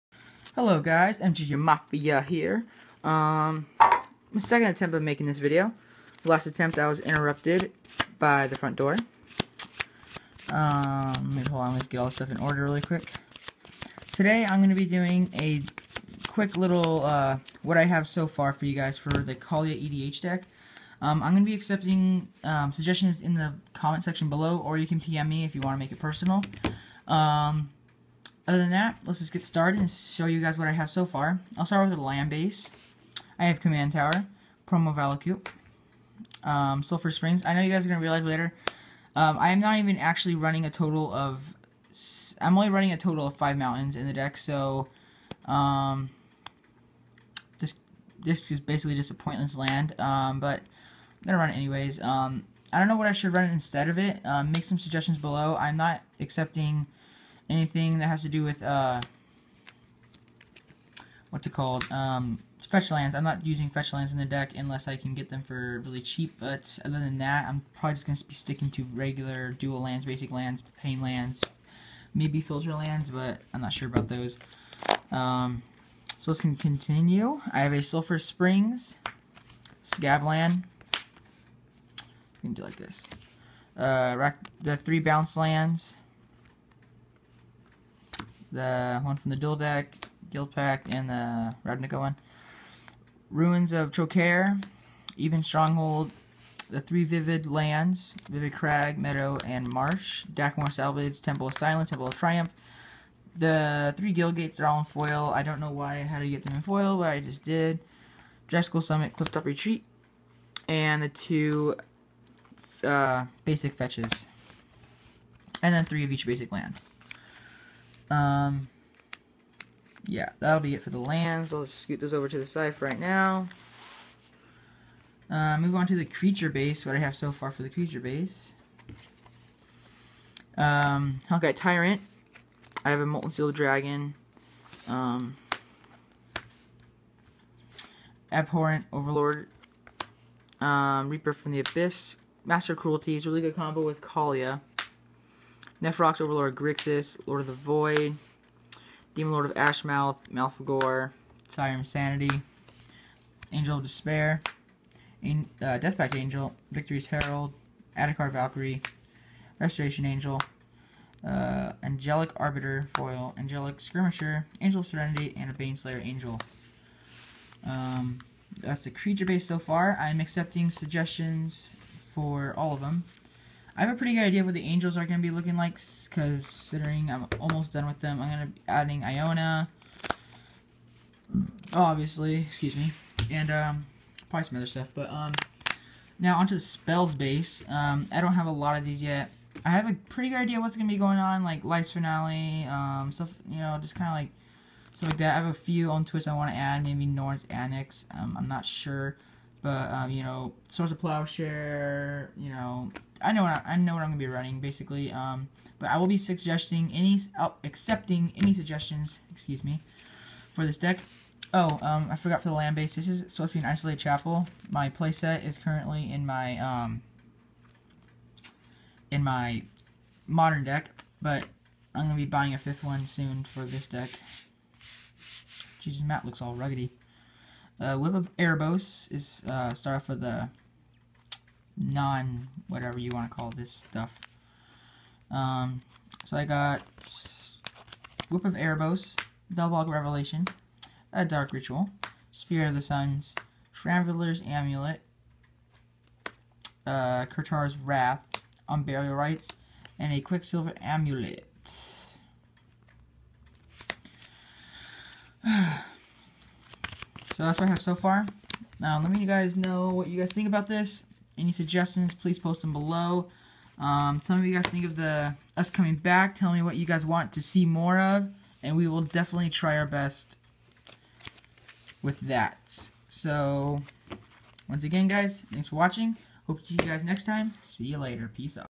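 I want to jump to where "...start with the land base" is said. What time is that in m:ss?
0:31.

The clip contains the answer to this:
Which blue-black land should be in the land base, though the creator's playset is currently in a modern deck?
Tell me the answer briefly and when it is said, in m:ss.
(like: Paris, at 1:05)
Isolated Chapel, at 3:33.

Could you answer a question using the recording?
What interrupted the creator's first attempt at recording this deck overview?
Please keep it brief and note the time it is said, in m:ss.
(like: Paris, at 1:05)
The front door, at 0:08.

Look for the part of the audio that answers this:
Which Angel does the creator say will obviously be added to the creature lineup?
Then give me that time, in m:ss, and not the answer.
2:59.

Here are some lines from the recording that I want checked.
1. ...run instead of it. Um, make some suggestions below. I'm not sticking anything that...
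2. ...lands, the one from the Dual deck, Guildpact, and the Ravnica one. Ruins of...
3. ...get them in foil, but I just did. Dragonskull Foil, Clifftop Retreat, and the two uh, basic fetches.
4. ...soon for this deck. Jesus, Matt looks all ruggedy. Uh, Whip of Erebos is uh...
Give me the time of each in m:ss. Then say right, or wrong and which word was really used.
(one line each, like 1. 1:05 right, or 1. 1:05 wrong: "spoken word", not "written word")
1. 0:53 wrong: "accepting", not "sticking"
2. 1:25 right
3. 1:46 wrong: "Summit", not "Foil"
4. 3:43 right.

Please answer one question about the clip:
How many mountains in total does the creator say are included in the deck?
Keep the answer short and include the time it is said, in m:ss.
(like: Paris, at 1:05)
5, at 0:43.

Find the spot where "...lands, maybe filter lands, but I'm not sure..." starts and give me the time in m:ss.
1:11.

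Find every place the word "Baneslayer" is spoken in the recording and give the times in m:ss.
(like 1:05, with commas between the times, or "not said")
2:45.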